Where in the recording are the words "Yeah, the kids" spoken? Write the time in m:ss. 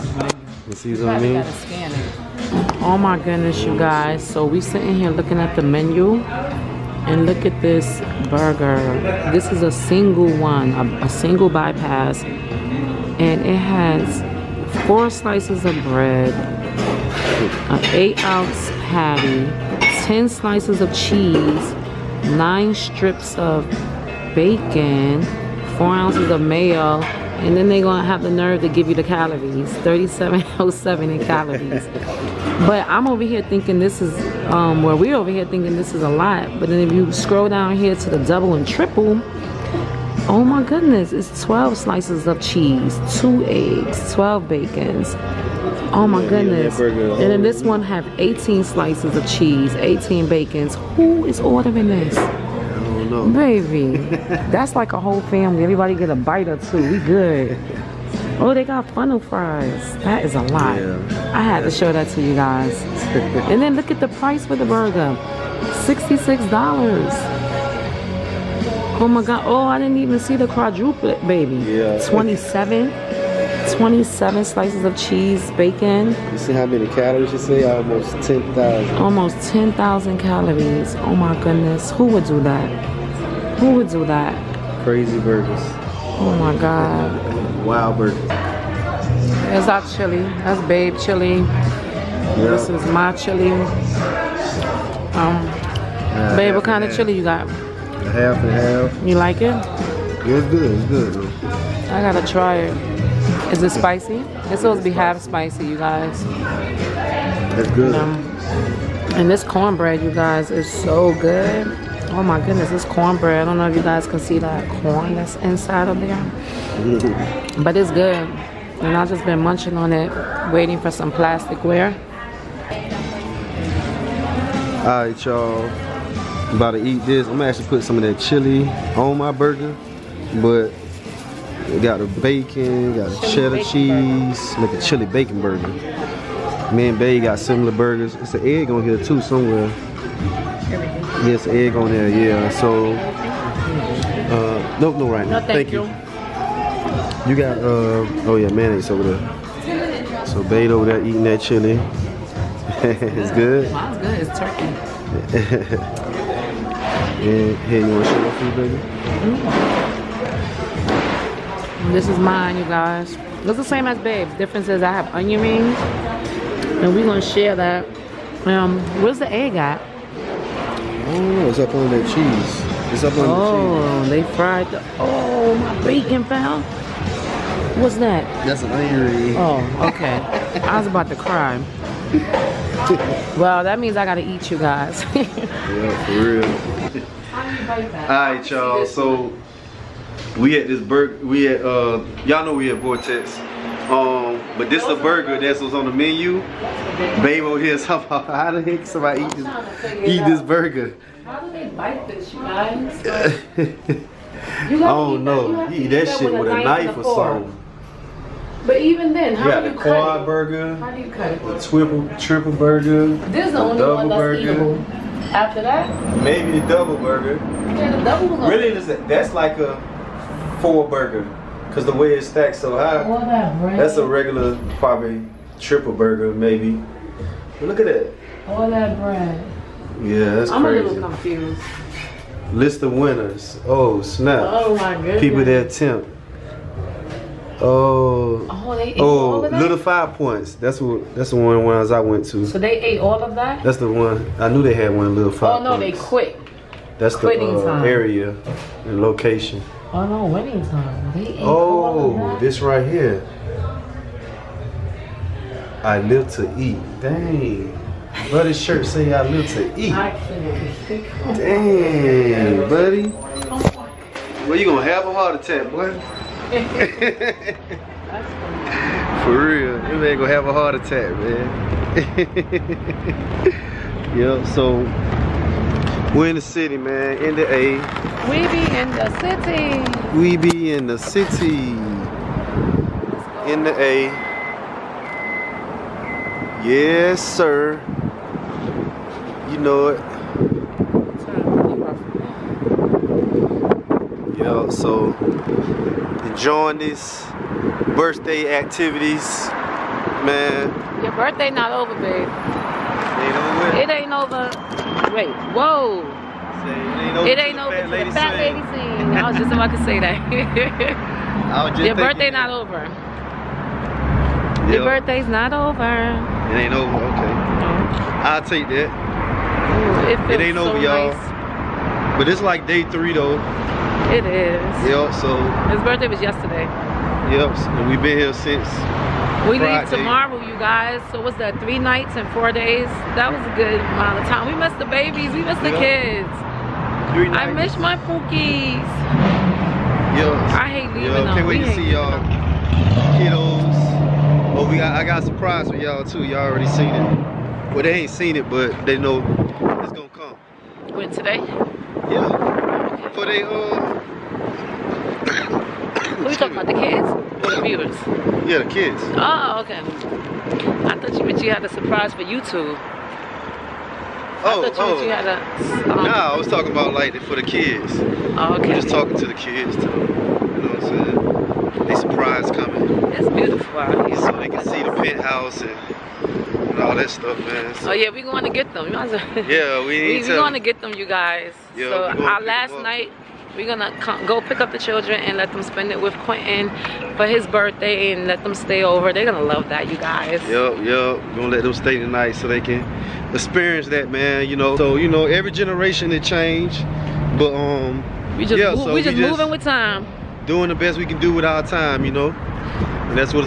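5:58.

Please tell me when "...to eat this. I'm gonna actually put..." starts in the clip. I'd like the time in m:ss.
2:06.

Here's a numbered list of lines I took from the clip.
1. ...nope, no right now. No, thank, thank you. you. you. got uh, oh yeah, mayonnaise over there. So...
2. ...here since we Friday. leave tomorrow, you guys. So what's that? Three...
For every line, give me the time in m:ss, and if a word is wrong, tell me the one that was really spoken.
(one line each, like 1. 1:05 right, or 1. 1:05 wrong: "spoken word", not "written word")
1. 2:24 right
2. 5:28 right.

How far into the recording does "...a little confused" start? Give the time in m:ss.
3:50.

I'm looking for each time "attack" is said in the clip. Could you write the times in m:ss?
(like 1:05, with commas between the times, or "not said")
4:25, 4:30.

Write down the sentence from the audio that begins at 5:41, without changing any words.
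Can't wait we to see y'all kiddos.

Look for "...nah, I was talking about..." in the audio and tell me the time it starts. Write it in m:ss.
6:06.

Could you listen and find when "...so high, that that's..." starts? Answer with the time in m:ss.
3:42.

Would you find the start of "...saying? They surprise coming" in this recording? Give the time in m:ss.
6:11.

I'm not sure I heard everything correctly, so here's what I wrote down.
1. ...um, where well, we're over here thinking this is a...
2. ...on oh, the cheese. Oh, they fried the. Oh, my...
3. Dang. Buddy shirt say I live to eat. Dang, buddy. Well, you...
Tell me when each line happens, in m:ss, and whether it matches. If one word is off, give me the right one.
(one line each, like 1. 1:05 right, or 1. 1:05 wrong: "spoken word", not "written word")
1. 0:34 right
2. 2:53 right
3. 4:17 right.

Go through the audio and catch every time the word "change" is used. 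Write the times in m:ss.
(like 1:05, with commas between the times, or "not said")
6:36.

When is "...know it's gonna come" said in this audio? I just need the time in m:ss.
5:48.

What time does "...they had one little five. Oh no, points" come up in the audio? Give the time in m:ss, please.
4:04.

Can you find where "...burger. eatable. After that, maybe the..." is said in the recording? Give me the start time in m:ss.
3:34.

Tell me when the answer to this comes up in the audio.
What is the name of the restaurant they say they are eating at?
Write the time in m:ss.
3:12.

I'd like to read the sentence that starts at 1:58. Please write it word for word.
And I've just been munching on it, waiting for some plasticware.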